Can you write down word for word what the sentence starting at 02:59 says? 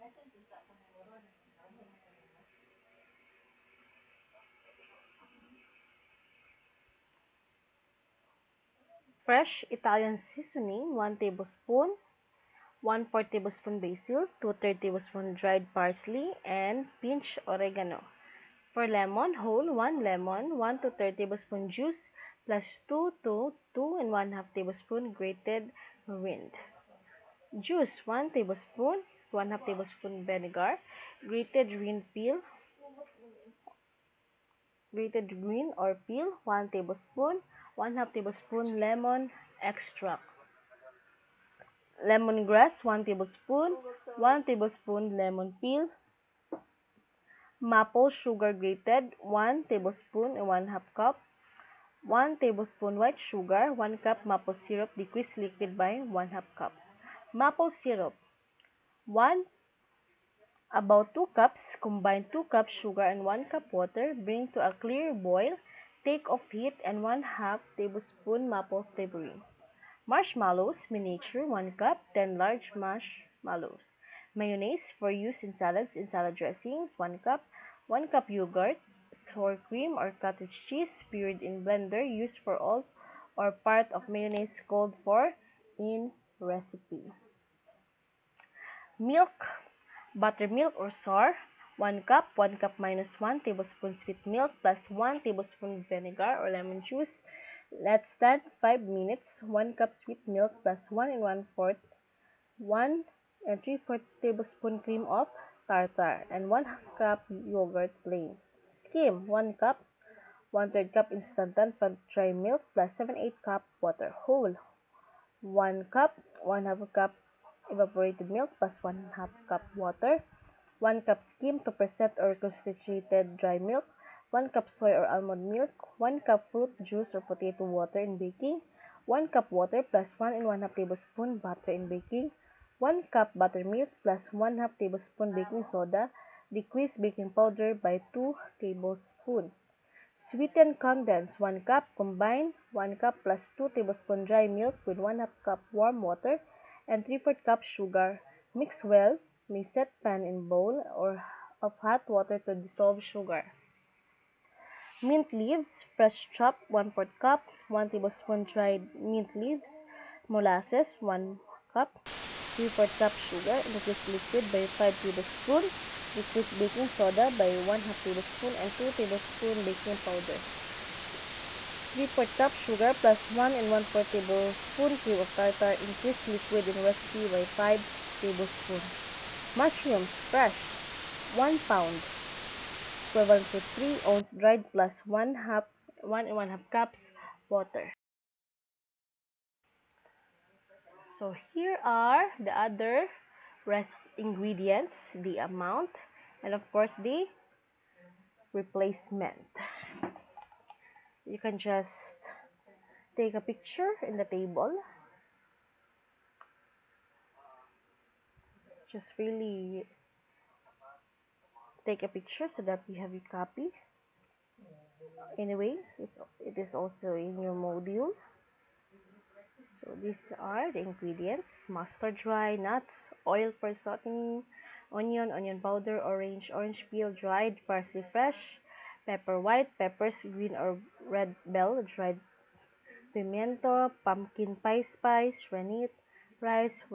Mushrooms, fresh, 1 pound equivalent to 3 ounce dried plus 1 half 1 and 1 half cups water.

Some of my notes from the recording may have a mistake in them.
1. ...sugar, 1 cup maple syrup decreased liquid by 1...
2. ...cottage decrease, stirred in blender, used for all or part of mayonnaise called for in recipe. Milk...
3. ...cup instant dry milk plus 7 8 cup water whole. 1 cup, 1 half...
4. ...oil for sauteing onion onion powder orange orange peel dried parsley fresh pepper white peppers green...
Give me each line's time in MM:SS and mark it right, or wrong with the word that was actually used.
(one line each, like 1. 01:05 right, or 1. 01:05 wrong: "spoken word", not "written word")
1. 00:53 right
2. 01:20 wrong: "cheese", not "decrease"
3. 01:50 right
4. 03:43 right.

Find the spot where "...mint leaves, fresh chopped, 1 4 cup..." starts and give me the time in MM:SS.
02:35.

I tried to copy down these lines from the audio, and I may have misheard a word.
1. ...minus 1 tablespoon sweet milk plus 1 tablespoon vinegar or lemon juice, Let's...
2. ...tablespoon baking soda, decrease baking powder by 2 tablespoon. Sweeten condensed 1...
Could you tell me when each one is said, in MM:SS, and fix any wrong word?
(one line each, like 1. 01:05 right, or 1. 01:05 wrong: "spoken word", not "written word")
1. 01:32 right
2. 02:14 right.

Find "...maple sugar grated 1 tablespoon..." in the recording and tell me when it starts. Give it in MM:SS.
00:47.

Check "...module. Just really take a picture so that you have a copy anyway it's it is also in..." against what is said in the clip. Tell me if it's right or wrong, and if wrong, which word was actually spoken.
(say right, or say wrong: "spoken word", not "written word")
wrong: "table", not "module".